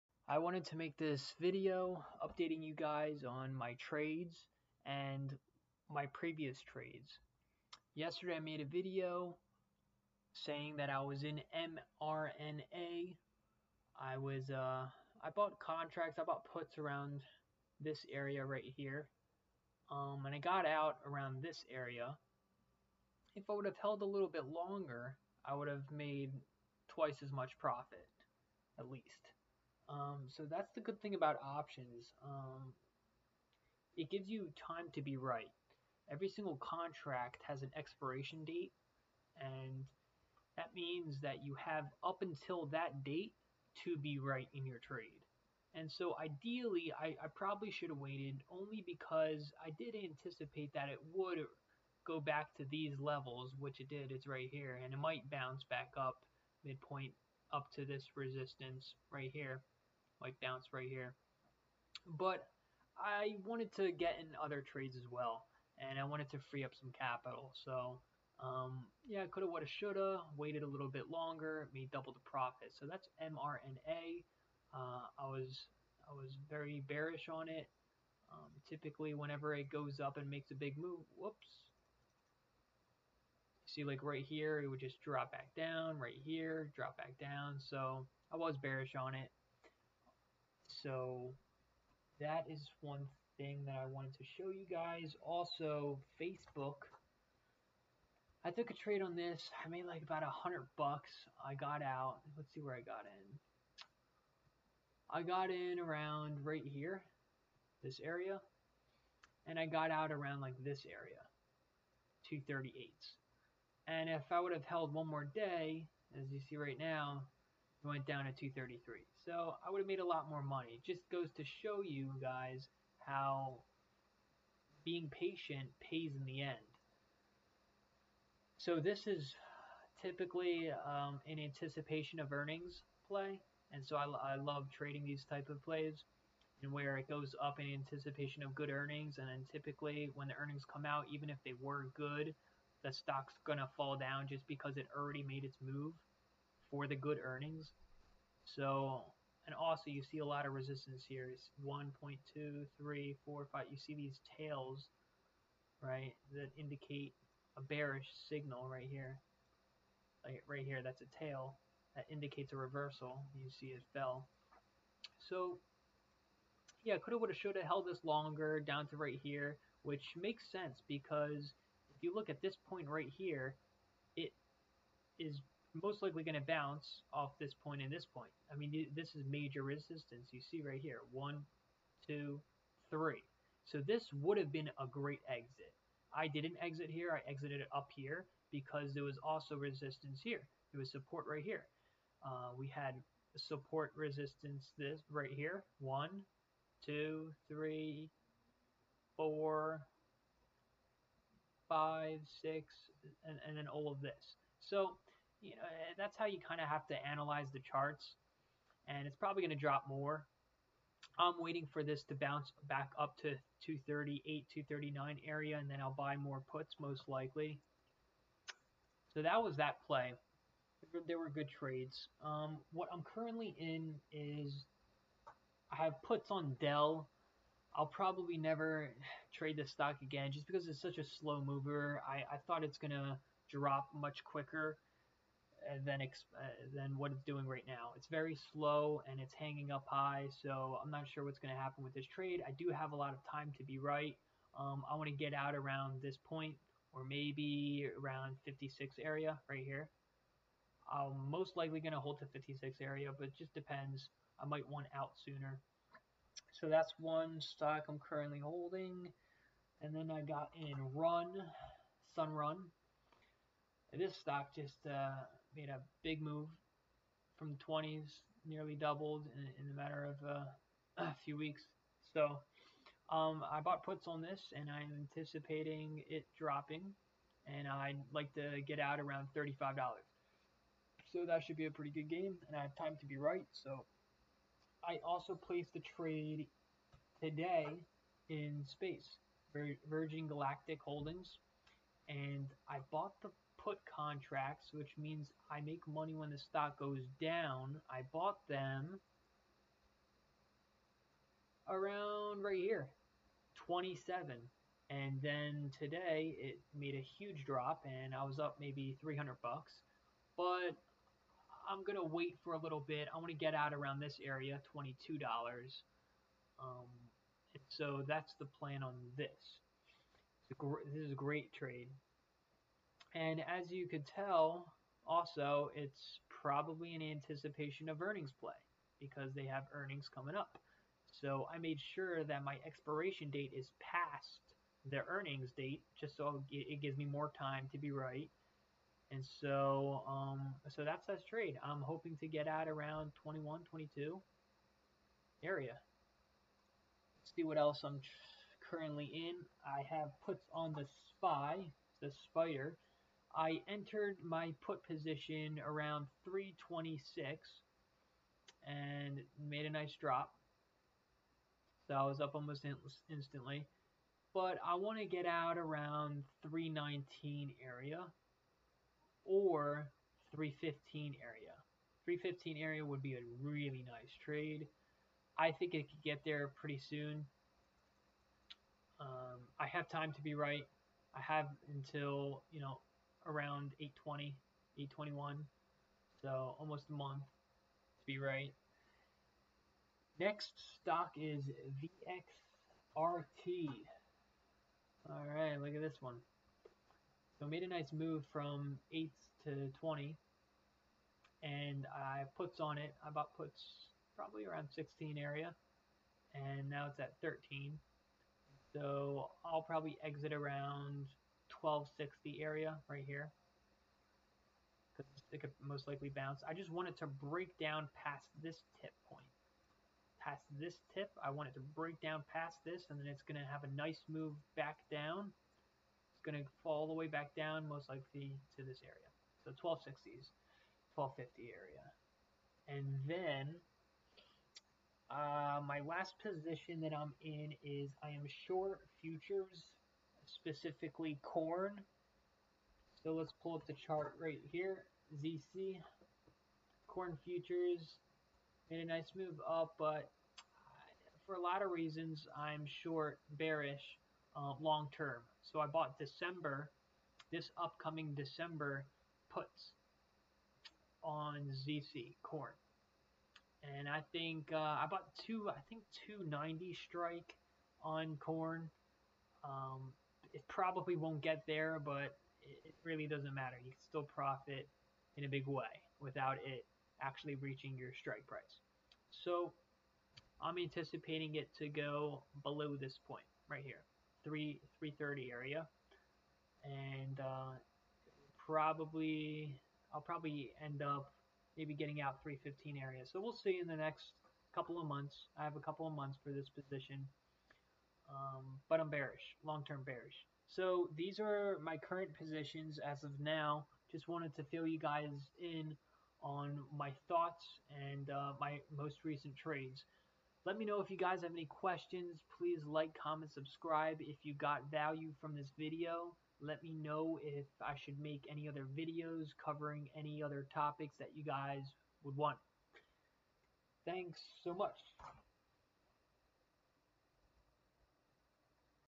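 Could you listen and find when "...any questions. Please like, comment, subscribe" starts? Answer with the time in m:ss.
8:31.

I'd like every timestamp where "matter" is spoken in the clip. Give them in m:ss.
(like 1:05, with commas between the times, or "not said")
4:29, 7:53.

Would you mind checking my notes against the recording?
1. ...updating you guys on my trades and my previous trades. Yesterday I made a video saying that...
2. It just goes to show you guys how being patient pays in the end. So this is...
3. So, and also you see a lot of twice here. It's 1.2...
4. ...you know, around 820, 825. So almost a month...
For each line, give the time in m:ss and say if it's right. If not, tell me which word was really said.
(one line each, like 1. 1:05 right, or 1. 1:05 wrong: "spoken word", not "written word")
1. 0:02 right
2. 2:00 right
3. 2:28 wrong: "resistance", not "twice"
4. 6:22 wrong: "821", not "825".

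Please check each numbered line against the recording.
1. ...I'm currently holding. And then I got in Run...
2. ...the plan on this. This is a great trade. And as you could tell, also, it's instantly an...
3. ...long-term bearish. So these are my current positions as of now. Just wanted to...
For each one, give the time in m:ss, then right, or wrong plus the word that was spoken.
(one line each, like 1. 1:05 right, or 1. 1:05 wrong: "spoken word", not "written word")
1. 4:17 right
2. 5:18 wrong: "probably", not "instantly"
3. 8:19 right.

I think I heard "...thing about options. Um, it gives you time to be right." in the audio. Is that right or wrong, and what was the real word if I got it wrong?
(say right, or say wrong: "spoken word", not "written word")
right.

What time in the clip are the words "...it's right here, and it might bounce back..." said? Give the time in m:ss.
0:54.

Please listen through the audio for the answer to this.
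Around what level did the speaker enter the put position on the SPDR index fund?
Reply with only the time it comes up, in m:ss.
5:56.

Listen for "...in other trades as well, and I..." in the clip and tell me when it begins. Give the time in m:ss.
1:04.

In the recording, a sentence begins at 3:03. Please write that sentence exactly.
So this would have been a great exit.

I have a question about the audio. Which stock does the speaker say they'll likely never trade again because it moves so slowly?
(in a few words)
Dell.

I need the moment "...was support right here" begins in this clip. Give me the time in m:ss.
3:10.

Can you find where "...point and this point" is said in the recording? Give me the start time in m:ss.
2:57.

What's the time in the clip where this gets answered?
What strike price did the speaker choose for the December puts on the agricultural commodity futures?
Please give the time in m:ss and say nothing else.
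7:46.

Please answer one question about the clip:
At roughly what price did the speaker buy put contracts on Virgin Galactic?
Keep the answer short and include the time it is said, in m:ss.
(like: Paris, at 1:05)
27, at 5:03.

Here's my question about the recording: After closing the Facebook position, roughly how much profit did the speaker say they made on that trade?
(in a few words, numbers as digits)
$100.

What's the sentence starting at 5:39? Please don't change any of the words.
And so, um, so that's that trade.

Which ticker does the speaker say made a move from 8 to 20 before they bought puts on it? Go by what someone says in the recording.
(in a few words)
VXRT.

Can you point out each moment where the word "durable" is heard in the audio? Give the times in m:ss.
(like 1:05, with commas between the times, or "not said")
not said.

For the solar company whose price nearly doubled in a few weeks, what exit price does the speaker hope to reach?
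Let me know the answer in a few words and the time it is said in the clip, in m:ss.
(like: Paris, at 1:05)
$35, at 4:39.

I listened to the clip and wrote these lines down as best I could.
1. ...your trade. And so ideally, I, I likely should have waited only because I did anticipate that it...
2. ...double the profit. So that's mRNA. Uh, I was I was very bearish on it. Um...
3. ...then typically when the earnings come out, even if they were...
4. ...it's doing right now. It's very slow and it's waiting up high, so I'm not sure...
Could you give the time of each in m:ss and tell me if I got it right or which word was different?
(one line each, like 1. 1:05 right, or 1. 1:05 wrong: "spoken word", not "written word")
1. 0:44 wrong: "probably", not "likely"
2. 1:11 right
3. 2:19 right
4. 3:57 wrong: "hanging", not "waiting".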